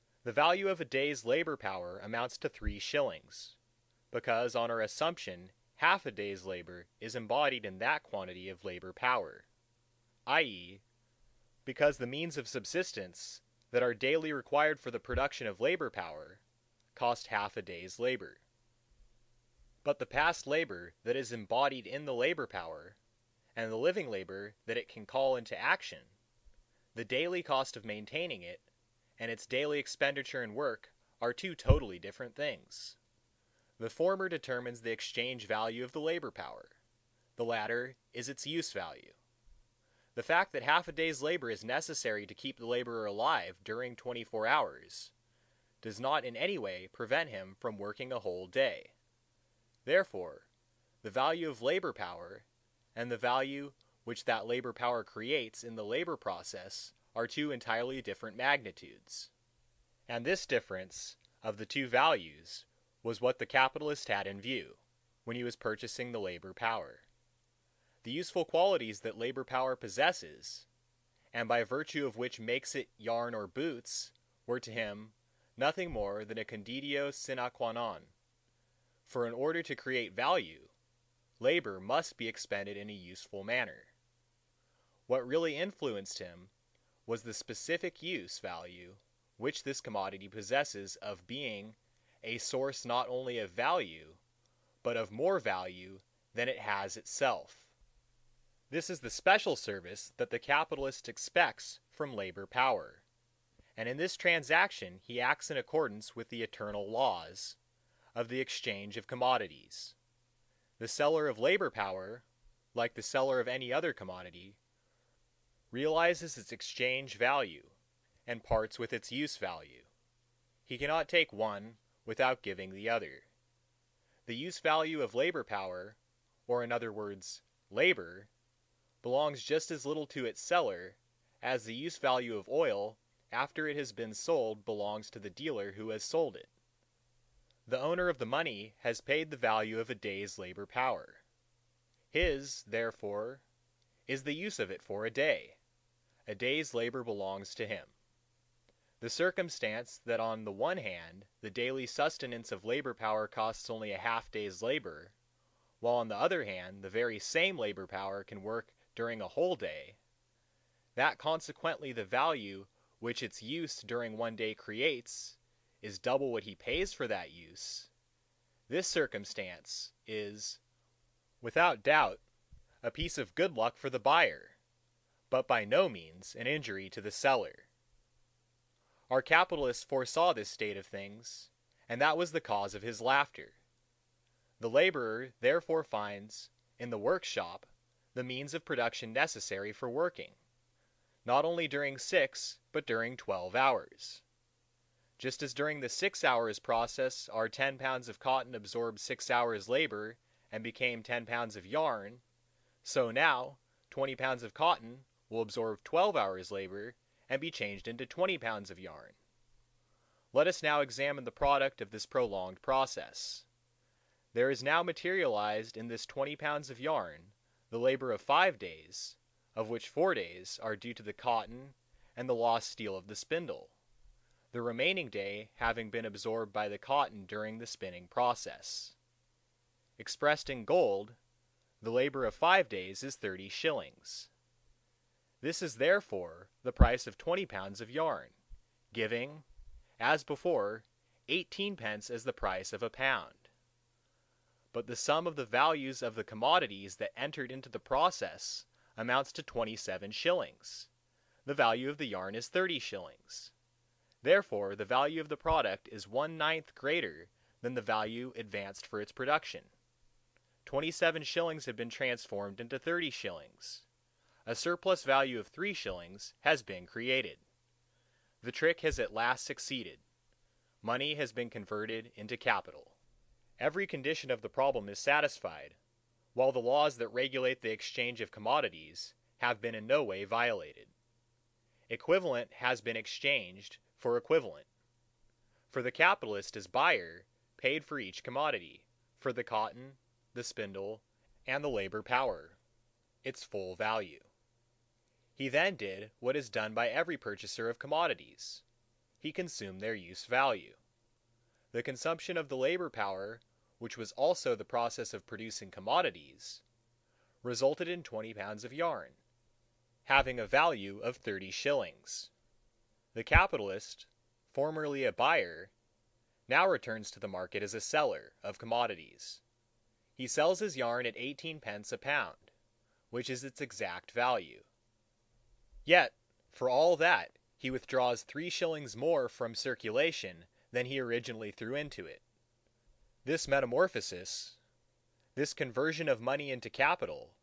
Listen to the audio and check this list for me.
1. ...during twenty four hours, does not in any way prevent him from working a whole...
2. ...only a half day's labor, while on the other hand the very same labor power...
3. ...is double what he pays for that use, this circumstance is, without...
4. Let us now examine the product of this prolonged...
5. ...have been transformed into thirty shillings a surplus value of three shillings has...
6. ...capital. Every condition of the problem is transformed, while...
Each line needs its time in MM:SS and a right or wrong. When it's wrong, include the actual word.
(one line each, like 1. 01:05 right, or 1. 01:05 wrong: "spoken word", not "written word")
1. 00:43 right
2. 02:33 right
3. 02:45 right
4. 03:30 right
5. 04:21 right
6. 04:32 wrong: "satisfied", not "transformed".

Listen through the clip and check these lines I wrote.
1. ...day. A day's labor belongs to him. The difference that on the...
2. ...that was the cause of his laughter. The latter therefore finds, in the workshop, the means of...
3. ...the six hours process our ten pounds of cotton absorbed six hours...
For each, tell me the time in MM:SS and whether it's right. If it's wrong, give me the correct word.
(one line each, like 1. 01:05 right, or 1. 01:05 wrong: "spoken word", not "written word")
1. 02:25 wrong: "circumstance", not "difference"
2. 03:02 wrong: "laborer", not "latter"
3. 03:15 right.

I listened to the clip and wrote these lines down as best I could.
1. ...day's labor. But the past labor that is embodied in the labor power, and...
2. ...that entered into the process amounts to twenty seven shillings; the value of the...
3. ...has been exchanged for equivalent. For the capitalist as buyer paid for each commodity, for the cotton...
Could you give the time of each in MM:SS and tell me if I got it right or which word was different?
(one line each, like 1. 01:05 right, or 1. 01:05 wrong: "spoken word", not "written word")
1. 00:17 right
2. 04:06 right
3. 04:42 right.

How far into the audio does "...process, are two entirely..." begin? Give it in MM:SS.
00:56.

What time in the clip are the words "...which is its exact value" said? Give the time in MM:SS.
05:23.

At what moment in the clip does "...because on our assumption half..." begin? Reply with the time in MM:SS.
00:04.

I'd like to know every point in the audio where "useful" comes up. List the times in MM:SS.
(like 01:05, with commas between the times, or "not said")
01:08, 01:22.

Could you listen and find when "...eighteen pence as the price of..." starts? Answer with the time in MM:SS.
04:01.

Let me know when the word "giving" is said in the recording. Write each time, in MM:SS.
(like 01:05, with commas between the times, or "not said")
02:02, 03:58.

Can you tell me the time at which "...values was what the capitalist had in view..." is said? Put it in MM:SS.
01:01.